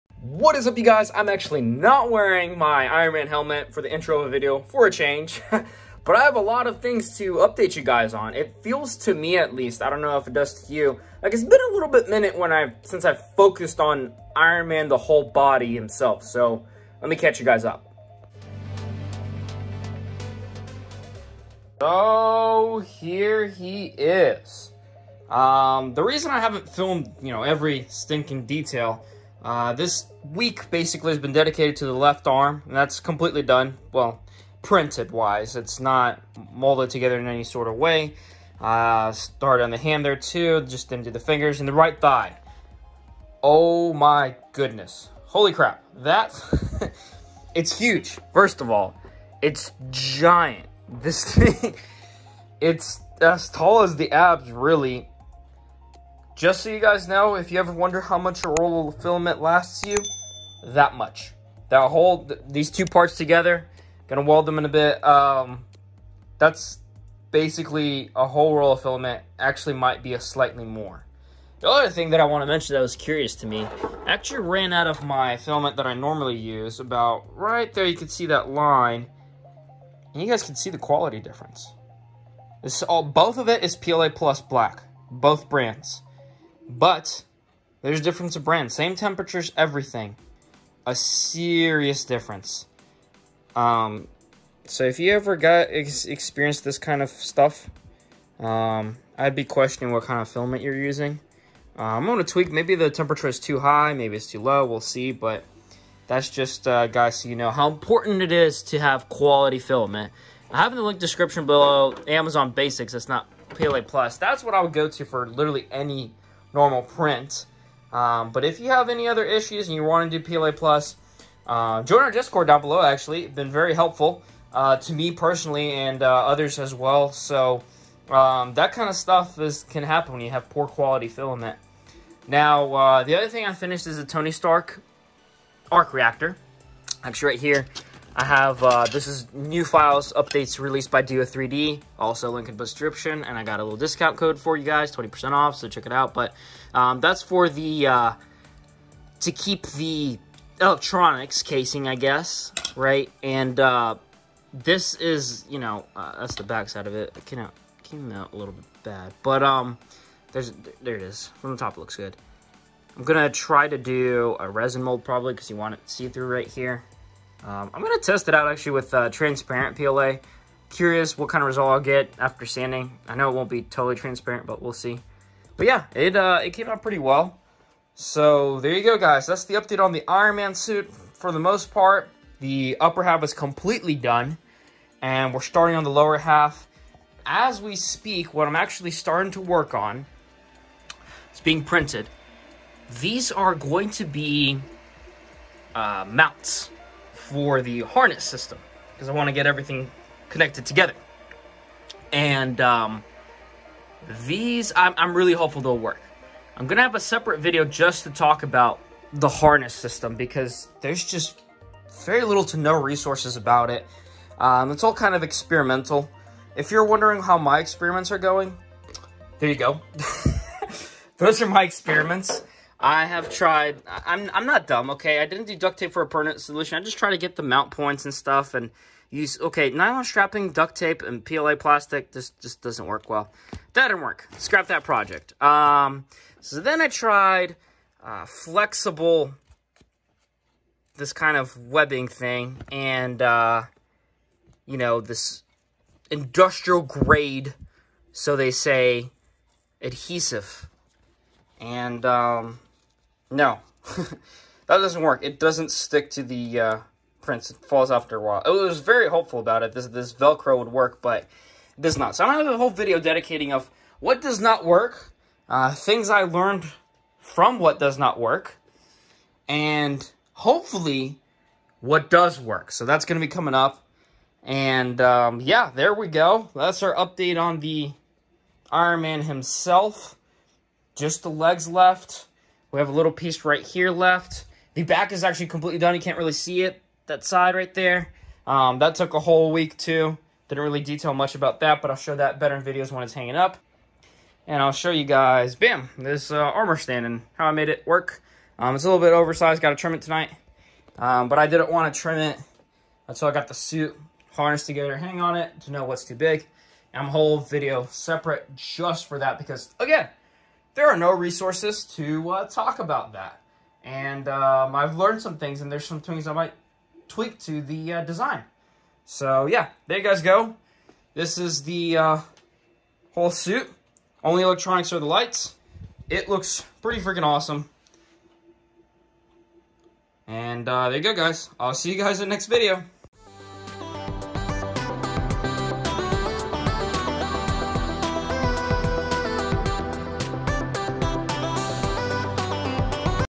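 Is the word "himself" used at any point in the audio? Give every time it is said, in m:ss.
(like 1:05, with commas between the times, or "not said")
0:15, 4:39.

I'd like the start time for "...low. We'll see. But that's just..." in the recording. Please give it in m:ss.
1:44.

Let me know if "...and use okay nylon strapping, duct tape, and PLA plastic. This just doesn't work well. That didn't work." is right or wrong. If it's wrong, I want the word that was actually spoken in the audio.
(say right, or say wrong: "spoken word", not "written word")
right.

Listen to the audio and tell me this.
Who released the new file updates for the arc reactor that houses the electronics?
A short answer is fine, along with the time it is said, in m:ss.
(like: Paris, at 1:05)
do3D, at 2:21.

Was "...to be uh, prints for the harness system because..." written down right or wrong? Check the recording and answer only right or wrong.
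wrong.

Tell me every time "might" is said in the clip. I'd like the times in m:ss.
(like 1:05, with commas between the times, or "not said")
1:09, 5:16.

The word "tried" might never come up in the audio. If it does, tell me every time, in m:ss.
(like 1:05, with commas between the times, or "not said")
3:43, 3:56.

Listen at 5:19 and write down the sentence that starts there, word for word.
So yeah, there you guys go.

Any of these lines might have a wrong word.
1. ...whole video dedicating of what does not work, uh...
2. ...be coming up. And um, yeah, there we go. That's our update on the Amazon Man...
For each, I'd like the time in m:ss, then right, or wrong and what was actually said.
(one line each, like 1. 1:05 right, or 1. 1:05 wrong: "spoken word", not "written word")
1. 4:22 right
2. 4:33 wrong: "Iron", not "Amazon".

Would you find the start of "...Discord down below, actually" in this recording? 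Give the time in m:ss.
2:02.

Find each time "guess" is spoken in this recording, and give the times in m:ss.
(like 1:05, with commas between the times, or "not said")
2:31.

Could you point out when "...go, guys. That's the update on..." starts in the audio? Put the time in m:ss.
2:58.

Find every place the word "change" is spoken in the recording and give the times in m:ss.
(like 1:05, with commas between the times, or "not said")
0:04.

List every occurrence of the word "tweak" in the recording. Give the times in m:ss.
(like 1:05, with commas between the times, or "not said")
1:42, 5:17.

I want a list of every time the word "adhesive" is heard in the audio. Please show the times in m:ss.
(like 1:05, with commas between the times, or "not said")
4:09.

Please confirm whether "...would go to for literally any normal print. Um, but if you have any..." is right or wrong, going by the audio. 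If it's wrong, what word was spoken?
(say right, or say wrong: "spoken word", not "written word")
right.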